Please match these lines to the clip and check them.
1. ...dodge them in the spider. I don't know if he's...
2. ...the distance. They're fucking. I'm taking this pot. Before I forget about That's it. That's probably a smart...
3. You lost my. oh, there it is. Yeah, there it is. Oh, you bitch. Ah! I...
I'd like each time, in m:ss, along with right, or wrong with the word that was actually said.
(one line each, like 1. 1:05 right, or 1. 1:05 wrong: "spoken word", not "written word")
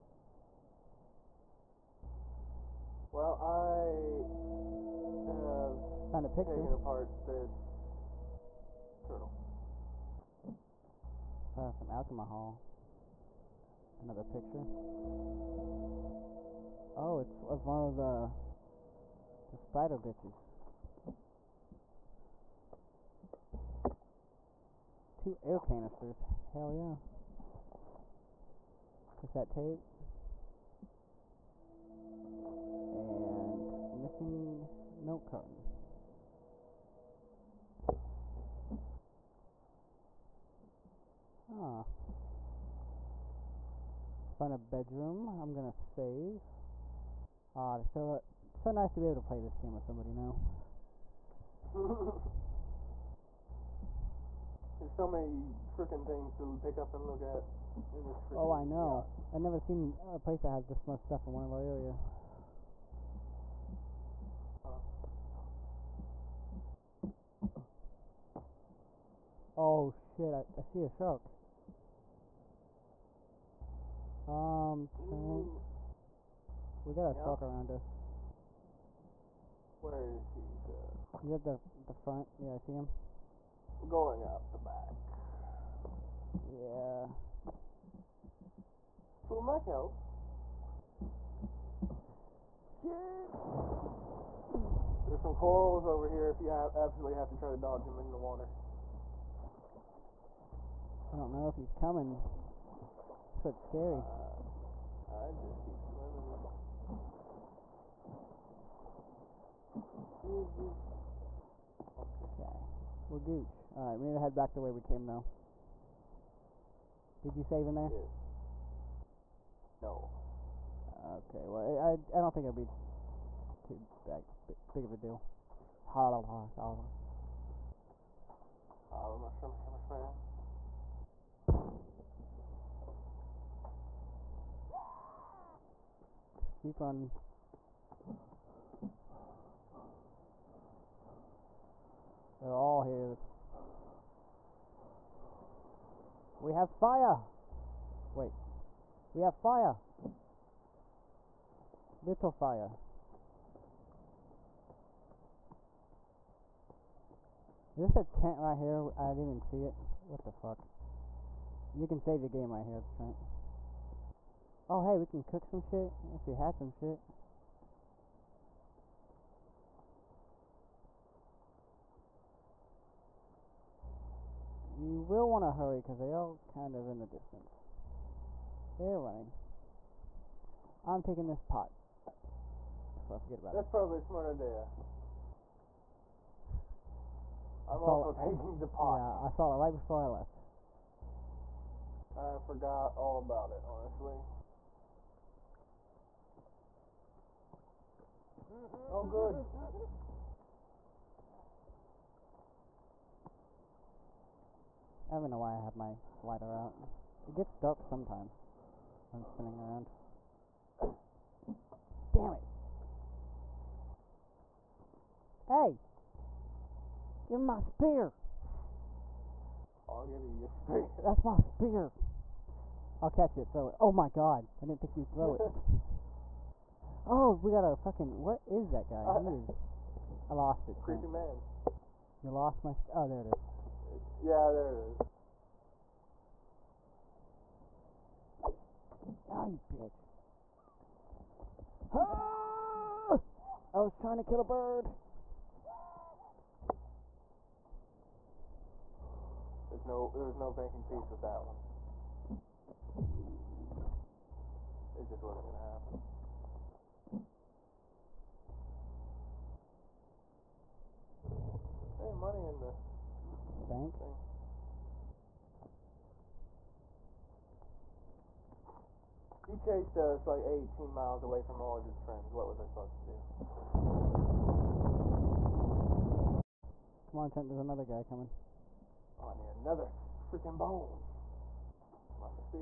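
1. 1:37 wrong: "water", not "spider"
2. 2:56 wrong: "running", not "fucking"
3. 3:52 right.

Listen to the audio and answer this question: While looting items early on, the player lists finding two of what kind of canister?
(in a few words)
Air canisters.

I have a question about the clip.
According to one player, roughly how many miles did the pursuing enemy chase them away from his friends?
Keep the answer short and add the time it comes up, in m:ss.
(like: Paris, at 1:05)
18, at 4:30.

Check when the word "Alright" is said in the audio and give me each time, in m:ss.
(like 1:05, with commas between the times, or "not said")
1:53.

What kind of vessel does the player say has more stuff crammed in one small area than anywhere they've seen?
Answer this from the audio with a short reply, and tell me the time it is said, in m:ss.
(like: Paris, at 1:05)
Yacht, at 0:58.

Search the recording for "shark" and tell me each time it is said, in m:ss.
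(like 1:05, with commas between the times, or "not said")
1:10, 1:17.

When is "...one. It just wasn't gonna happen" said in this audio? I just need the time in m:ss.
4:11.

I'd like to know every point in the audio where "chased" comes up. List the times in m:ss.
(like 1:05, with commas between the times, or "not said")
4:29.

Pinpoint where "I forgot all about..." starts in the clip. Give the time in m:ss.
3:12.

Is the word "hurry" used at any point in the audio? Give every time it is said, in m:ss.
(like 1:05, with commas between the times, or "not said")
2:55.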